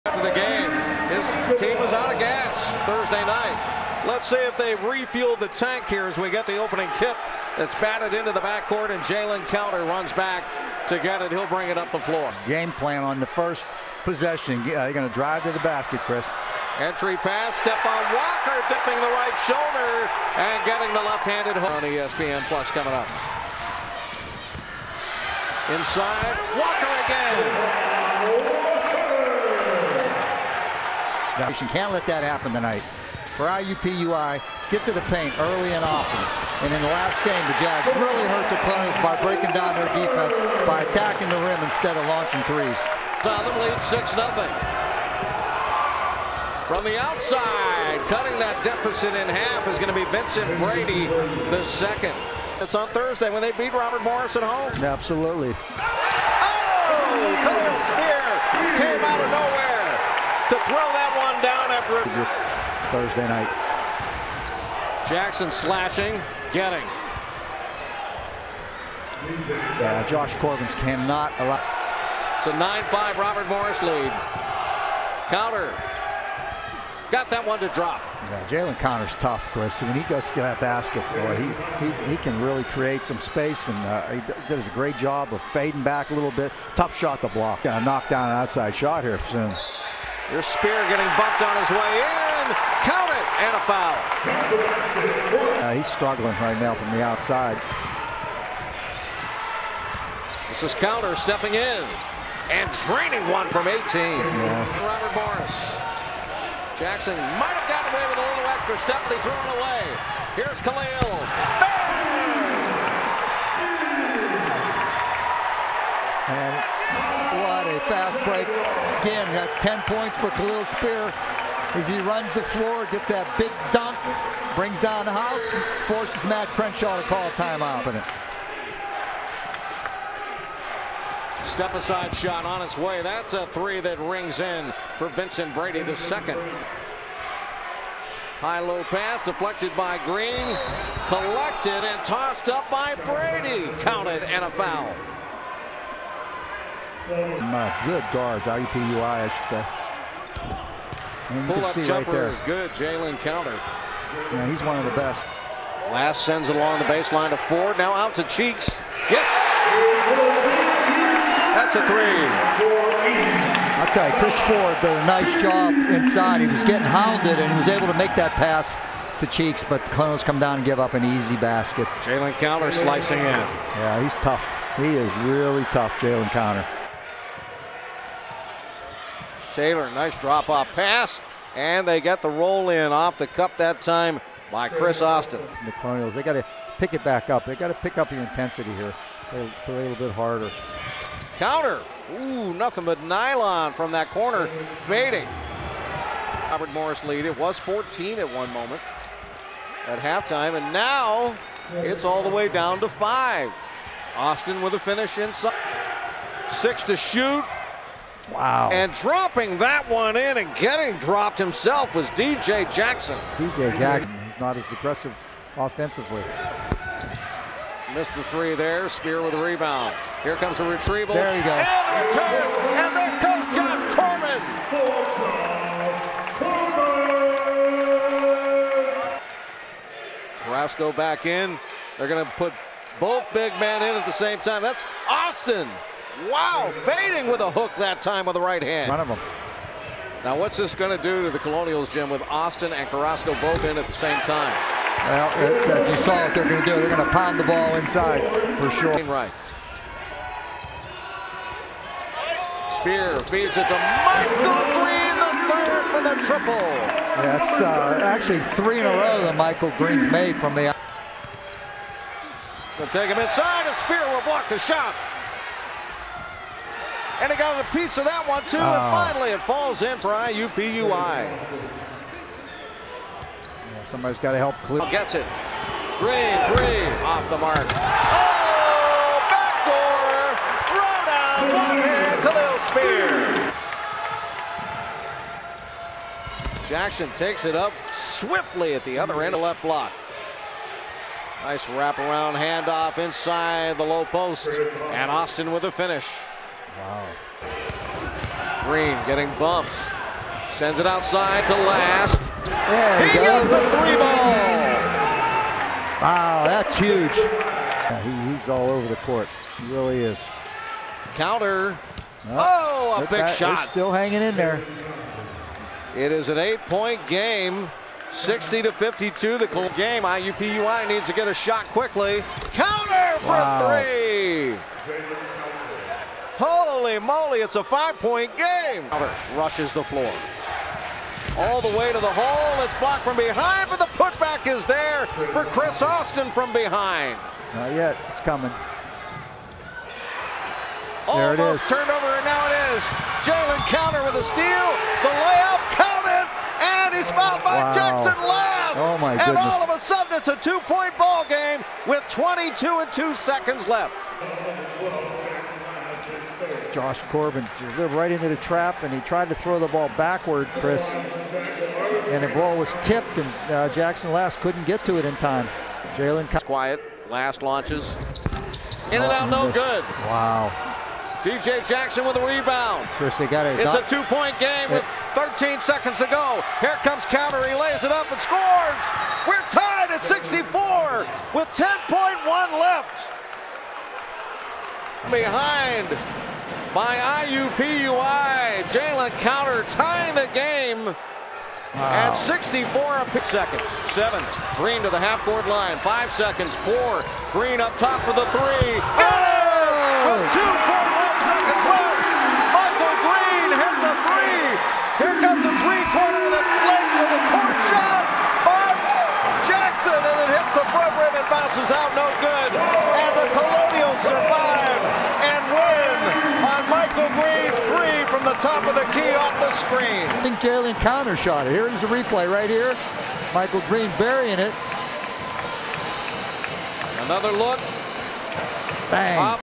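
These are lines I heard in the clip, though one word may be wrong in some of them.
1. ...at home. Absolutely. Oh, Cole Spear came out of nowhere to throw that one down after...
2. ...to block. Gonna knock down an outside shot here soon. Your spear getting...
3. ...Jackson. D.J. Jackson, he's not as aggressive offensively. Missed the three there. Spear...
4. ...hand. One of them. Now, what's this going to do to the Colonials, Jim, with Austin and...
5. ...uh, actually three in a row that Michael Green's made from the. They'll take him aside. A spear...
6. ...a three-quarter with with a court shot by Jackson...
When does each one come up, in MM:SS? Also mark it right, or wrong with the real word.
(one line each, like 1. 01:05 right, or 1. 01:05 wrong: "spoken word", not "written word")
1. 00:54 right
2. 01:27 right
3. 03:32 right
4. 03:58 right
5. 04:17 wrong: "inside", not "aside"
6. 06:45 right.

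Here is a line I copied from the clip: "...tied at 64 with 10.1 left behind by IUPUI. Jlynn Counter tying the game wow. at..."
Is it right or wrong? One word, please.
right.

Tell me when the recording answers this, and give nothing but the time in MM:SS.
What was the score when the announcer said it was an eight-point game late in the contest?
05:18.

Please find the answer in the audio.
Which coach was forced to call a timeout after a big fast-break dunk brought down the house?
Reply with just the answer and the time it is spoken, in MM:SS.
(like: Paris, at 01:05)
Matt Crenshaw, at 02:06.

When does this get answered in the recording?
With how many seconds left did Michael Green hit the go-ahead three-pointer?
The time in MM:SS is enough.
06:40.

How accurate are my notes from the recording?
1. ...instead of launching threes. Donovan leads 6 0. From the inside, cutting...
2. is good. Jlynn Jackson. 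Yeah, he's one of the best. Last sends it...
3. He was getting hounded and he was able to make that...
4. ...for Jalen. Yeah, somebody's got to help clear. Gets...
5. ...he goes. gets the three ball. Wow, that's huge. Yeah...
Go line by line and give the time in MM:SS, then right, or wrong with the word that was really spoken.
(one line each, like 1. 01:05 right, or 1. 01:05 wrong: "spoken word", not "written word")
1. 00:41 wrong: "outside", not "inside"
2. 02:32 wrong: "Counter", not "Jackson"
3. 02:46 right
4. 04:29 wrong: "IUPUI", not "Jalen"
5. 05:03 right.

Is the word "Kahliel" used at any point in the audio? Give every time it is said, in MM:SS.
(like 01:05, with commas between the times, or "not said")
01:50, 02:00, 04:46.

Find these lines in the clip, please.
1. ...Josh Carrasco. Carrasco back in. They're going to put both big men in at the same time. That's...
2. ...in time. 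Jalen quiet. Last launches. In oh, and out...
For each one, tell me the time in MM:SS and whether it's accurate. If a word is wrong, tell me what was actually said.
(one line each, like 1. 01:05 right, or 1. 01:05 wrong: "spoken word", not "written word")
1. 03:43 wrong: "Corbin", not "Carrasco"
2. 06:05 right.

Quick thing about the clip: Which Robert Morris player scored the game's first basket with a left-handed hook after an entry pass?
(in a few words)
Stephaun Walker.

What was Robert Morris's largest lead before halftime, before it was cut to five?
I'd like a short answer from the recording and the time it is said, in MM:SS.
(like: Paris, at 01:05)
14, at 03:17.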